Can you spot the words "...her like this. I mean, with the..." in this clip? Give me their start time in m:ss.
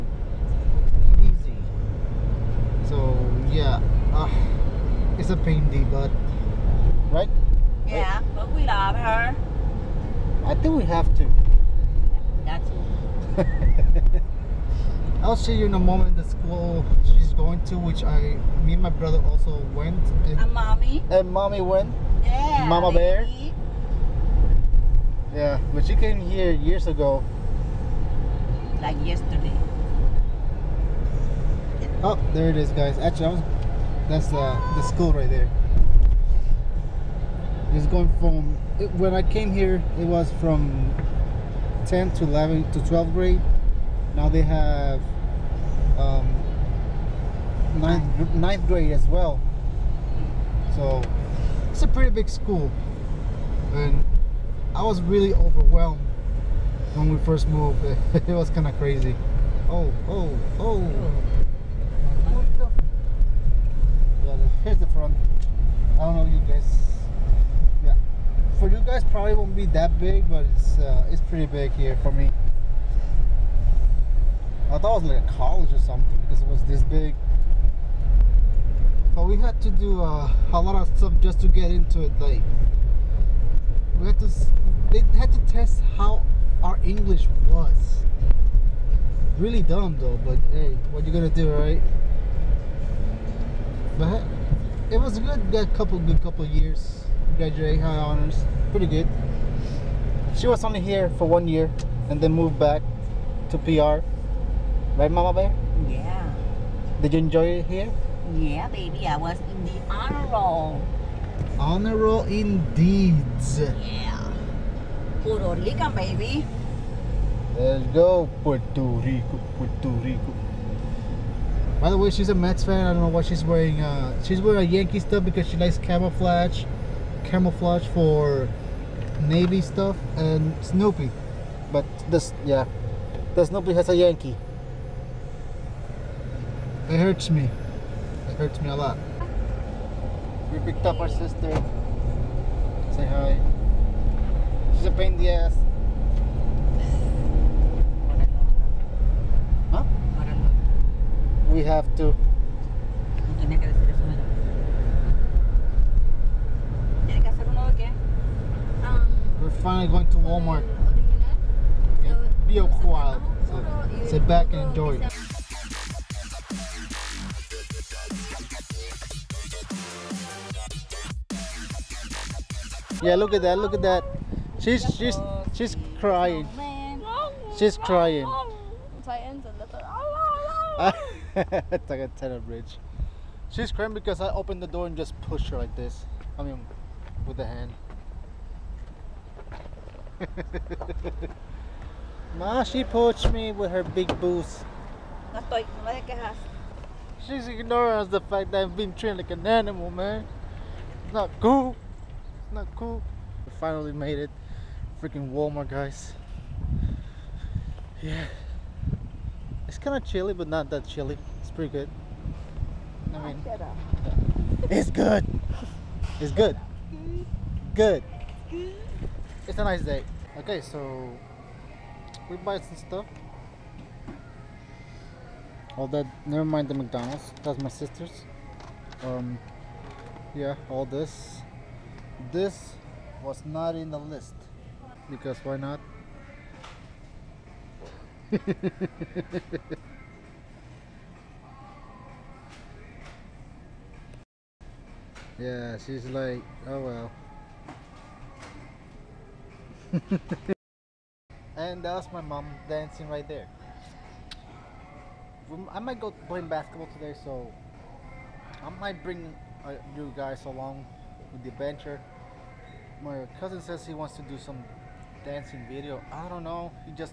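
3:05.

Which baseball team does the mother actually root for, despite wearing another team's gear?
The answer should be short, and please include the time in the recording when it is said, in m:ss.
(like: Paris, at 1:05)
Mets, at 2:02.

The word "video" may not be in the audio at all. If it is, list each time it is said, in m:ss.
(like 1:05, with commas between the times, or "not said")
4:25.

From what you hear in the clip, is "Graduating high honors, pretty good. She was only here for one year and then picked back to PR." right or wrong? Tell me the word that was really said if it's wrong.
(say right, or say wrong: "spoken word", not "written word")
wrong: "moved", not "picked".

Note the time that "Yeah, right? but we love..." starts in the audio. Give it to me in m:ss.
0:07.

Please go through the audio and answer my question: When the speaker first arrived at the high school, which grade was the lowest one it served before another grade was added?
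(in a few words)
10th grade.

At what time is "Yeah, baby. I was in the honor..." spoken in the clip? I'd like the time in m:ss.
1:48.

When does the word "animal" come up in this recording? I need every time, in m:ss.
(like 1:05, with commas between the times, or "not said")
3:19.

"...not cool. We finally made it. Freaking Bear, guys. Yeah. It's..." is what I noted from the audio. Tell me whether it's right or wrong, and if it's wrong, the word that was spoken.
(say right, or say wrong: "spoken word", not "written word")
wrong: "Walmart", not "Bear".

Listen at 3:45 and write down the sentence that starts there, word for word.
All that, never mind the McDonald's.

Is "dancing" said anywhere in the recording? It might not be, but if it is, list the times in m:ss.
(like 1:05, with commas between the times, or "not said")
4:12, 4:25.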